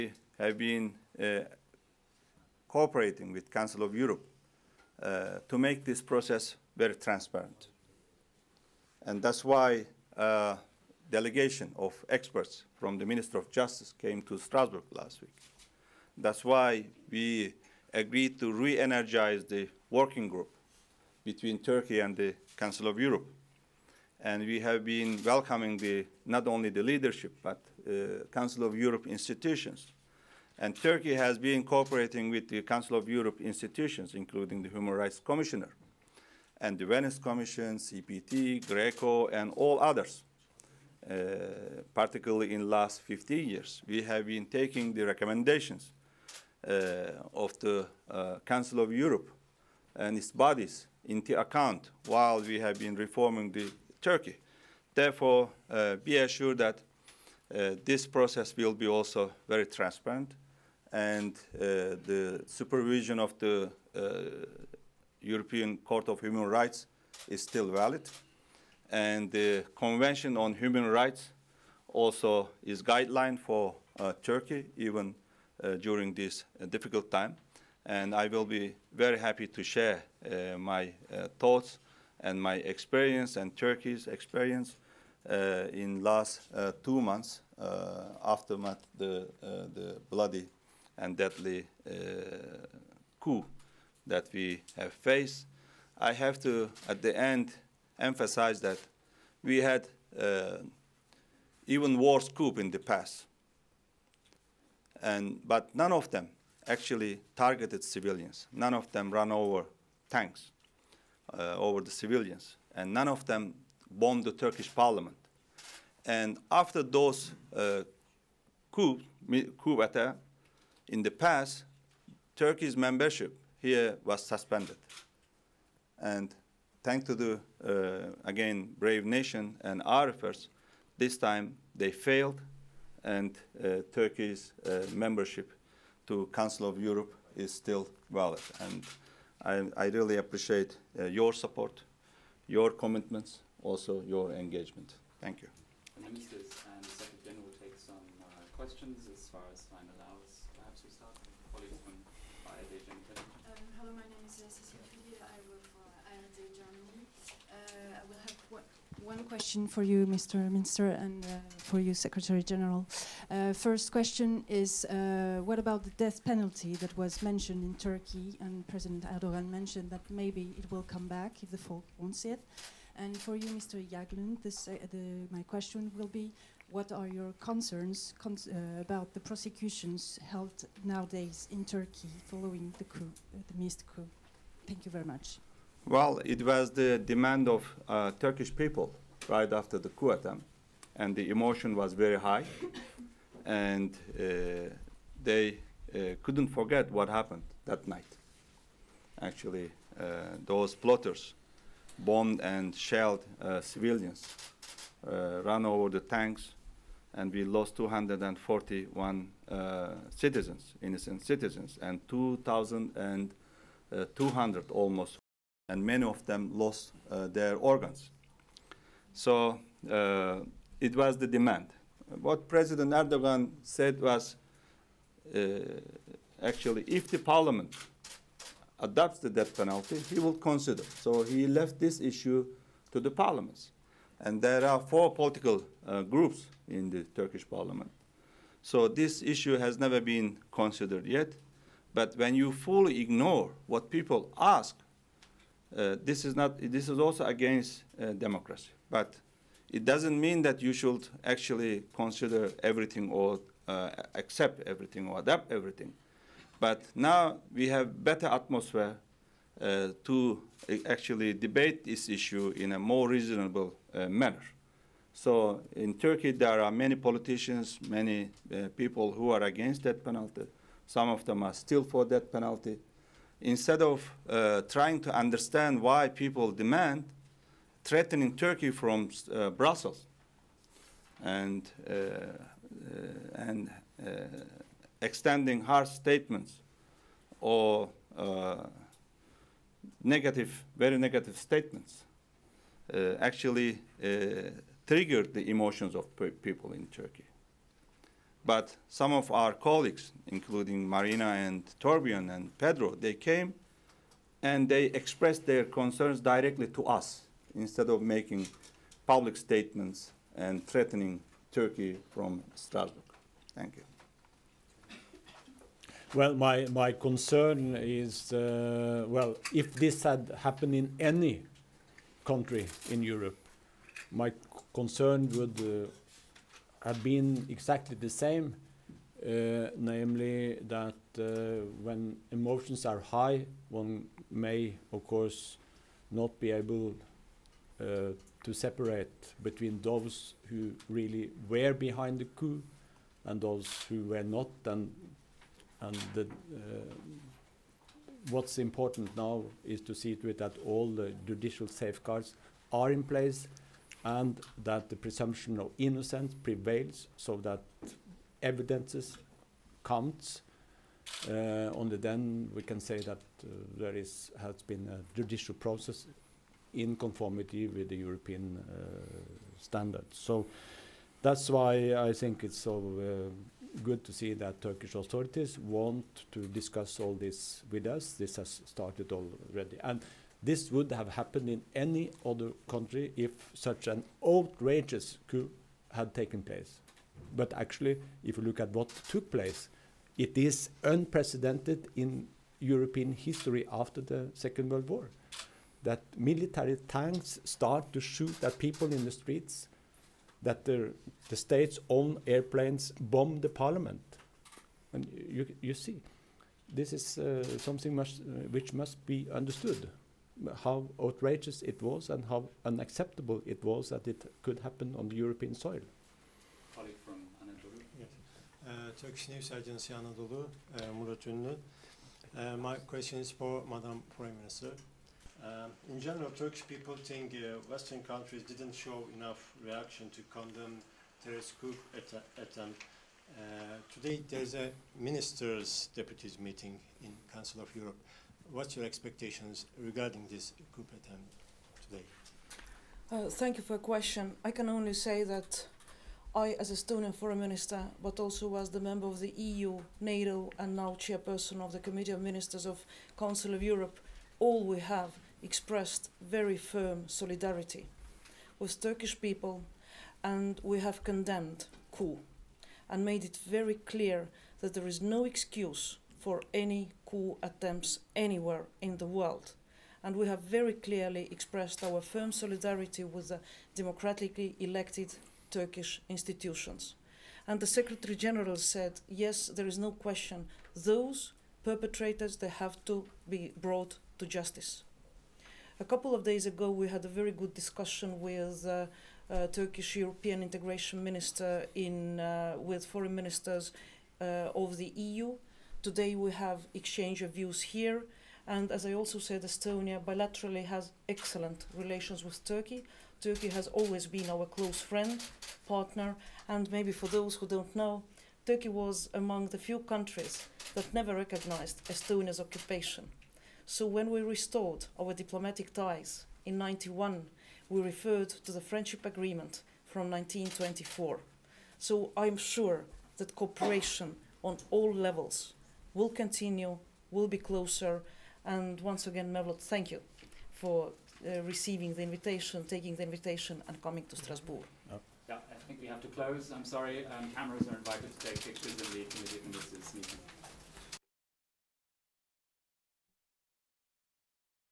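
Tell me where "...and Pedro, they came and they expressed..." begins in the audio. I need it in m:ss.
5:02.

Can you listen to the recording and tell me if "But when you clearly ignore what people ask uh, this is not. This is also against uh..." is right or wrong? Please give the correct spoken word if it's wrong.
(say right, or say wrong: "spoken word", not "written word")
wrong: "fully", not "clearly".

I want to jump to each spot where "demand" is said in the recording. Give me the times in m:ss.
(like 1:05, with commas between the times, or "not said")
3:06, 3:41, 4:36.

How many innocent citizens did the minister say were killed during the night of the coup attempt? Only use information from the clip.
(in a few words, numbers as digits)
241.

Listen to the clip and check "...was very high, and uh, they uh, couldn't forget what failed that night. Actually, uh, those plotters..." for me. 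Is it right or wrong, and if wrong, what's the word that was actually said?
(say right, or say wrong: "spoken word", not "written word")
wrong: "happened", not "failed".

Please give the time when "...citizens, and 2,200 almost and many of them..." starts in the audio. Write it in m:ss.
3:31.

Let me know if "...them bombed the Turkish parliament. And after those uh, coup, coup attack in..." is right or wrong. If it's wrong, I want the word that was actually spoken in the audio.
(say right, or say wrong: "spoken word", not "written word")
right.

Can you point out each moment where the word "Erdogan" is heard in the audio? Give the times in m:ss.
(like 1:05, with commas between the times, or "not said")
2:49, 3:42.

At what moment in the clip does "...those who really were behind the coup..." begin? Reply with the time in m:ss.
5:39.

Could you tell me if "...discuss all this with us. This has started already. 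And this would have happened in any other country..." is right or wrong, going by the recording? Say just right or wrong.
right.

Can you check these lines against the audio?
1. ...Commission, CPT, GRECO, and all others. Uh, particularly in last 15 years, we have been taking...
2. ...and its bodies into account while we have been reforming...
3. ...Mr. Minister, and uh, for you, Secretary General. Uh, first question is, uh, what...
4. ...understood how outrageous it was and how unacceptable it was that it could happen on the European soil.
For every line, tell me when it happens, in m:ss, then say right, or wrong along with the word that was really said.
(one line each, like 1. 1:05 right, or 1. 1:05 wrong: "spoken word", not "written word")
1. 0:37 right
2. 0:49 right
3. 2:40 right
4. 6:49 right.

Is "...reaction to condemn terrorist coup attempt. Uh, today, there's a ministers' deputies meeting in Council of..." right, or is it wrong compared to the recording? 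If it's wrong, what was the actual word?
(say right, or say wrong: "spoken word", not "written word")
right.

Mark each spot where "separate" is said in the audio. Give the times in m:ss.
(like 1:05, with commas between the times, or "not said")
5:38.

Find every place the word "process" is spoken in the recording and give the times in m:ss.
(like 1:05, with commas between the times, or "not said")
0:06, 0:58, 6:05.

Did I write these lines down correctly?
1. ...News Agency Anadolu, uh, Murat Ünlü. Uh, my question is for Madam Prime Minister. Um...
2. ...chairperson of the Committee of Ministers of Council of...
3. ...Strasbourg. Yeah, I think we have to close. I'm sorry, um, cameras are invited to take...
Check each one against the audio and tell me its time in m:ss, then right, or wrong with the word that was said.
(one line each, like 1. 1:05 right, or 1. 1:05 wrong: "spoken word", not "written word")
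1. 6:59 right
2. 7:30 right
3. 8:54 right.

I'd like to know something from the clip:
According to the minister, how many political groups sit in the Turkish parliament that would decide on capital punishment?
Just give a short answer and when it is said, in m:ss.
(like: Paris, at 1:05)
4, at 3:54.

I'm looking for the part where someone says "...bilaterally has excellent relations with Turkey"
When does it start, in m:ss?
8:19.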